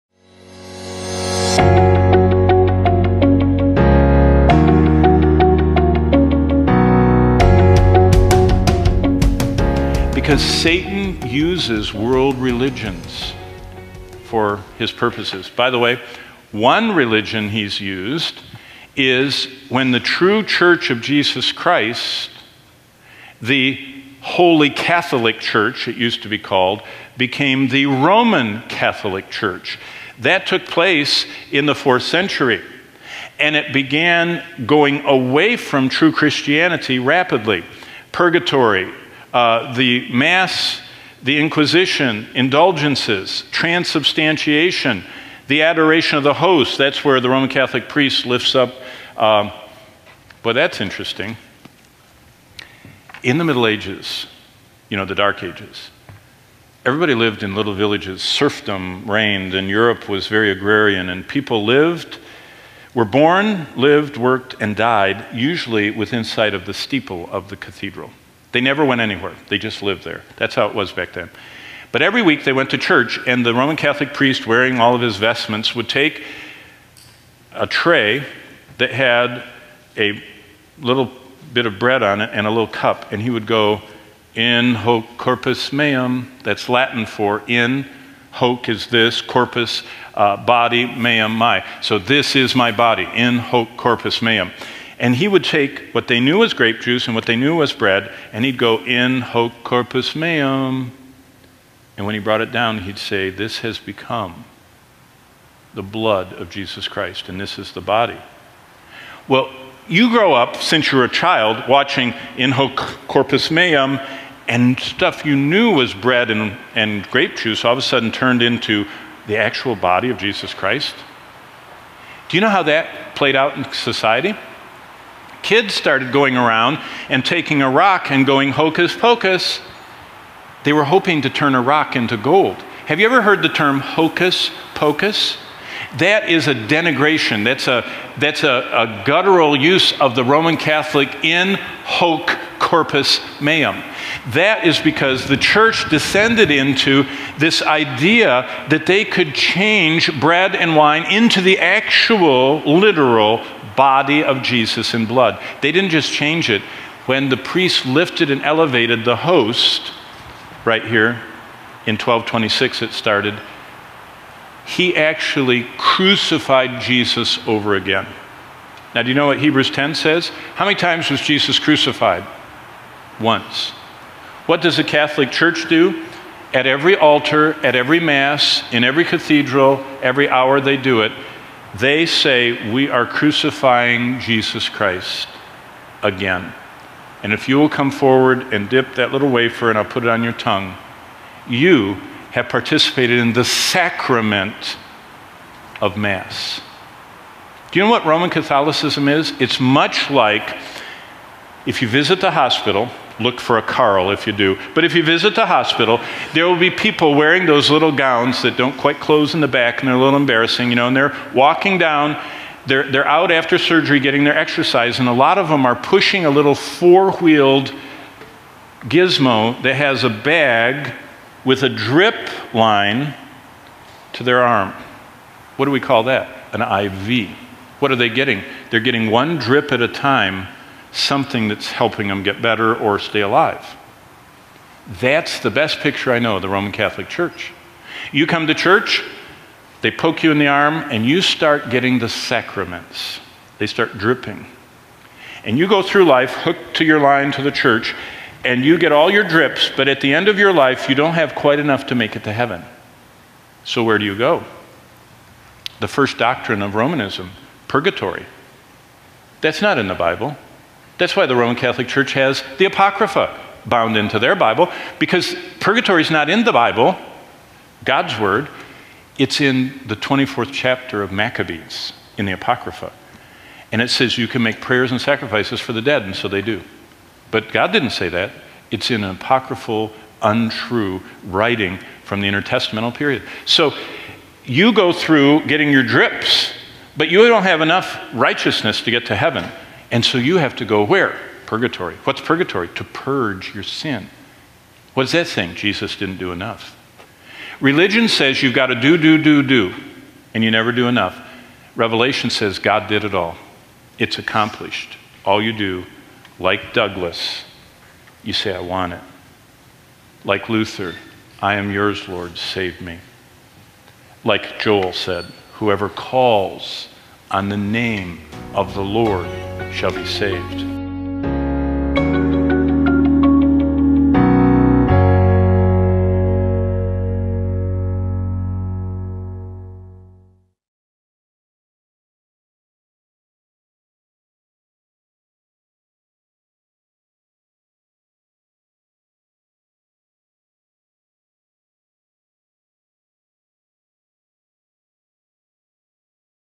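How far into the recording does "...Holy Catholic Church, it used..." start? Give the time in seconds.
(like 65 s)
24 s.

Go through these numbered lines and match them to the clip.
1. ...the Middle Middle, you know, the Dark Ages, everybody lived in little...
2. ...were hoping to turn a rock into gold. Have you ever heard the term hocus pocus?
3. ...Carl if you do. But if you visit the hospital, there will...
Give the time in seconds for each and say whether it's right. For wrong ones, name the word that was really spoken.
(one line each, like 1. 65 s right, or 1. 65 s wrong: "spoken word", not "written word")
1. 53 s wrong: "Ages", not "Middle"
2. 130 s right
3. 203 s right.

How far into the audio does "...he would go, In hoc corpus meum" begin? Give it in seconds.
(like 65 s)
83 s.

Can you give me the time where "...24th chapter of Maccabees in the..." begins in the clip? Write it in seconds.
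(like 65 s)
269 s.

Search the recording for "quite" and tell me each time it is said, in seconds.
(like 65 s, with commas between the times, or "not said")
208 s, 251 s.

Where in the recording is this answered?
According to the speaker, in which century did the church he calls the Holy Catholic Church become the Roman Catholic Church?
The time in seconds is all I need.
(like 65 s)
31 s.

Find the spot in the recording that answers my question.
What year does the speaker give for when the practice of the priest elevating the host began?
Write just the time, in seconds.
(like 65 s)
161 s.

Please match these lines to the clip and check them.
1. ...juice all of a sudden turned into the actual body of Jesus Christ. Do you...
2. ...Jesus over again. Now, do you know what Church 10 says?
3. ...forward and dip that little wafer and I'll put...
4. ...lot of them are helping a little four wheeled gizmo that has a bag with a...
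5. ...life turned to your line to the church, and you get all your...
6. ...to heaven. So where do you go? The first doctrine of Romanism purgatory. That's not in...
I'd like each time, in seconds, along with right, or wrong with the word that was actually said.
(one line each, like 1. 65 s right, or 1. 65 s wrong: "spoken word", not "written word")
1. 117 s right
2. 166 s wrong: "Hebrews", not "Church"
3. 187 s right
4. 215 s wrong: "pushing", not "helping"
5. 246 s wrong: "hooked", not "turned"
6. 252 s right.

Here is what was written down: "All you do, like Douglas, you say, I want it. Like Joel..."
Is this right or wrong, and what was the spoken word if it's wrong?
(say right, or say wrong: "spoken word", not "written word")
wrong: "Luther", not "Joel".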